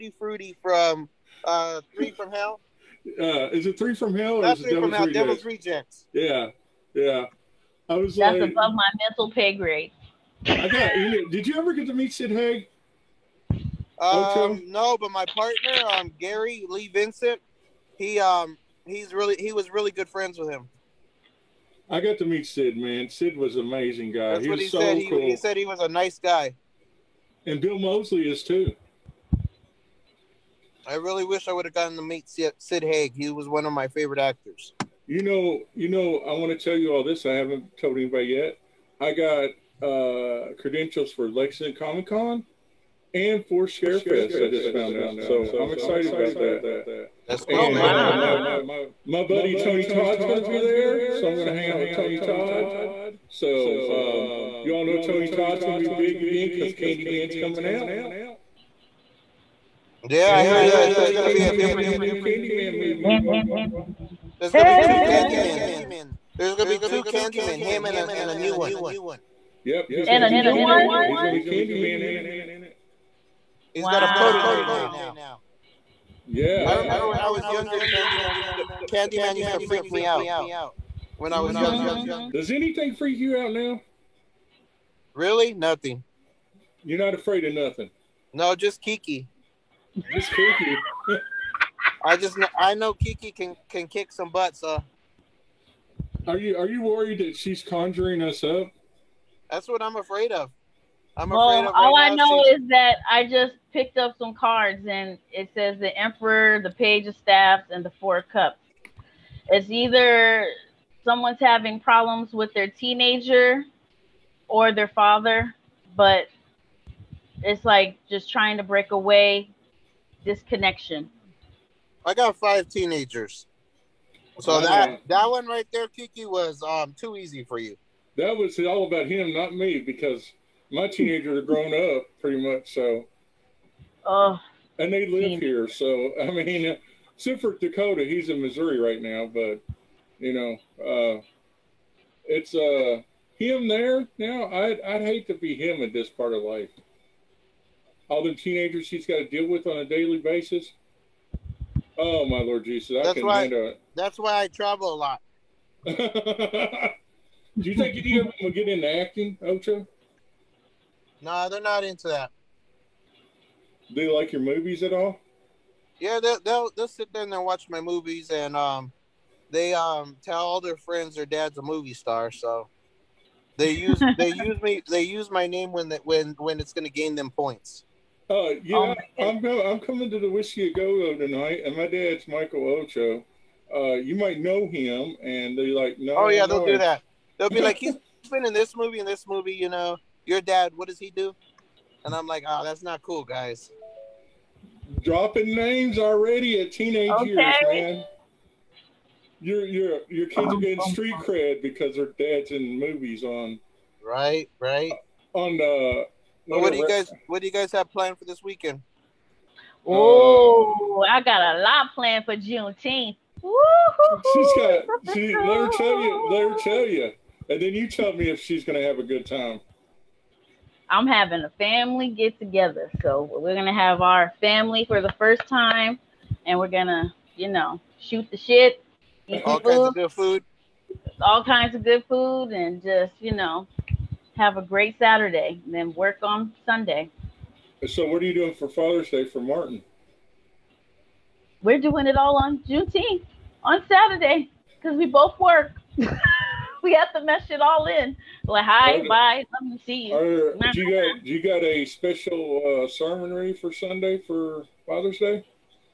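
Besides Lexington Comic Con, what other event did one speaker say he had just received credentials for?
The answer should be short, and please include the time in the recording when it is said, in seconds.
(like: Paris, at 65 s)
Scarefest, at 43 s.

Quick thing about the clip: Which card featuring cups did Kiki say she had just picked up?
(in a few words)
Four Cups.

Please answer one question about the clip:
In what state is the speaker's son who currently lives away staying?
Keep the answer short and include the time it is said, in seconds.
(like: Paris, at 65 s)
Missouri, at 138 s.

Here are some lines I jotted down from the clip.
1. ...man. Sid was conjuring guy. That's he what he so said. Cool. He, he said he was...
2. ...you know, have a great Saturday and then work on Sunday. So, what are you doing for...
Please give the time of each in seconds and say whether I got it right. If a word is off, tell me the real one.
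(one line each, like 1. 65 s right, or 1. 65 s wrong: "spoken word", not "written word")
1. 22 s wrong: "amazing", not "conjuring"
2. 233 s right.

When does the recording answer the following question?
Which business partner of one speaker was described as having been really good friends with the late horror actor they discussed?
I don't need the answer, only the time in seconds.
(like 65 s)
16 s.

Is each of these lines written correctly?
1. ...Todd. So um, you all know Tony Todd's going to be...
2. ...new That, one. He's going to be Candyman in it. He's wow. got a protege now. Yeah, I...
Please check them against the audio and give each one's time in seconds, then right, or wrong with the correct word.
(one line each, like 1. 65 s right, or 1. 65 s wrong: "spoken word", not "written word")
1. 52 s right
2. 70 s wrong: "Candy", not "That".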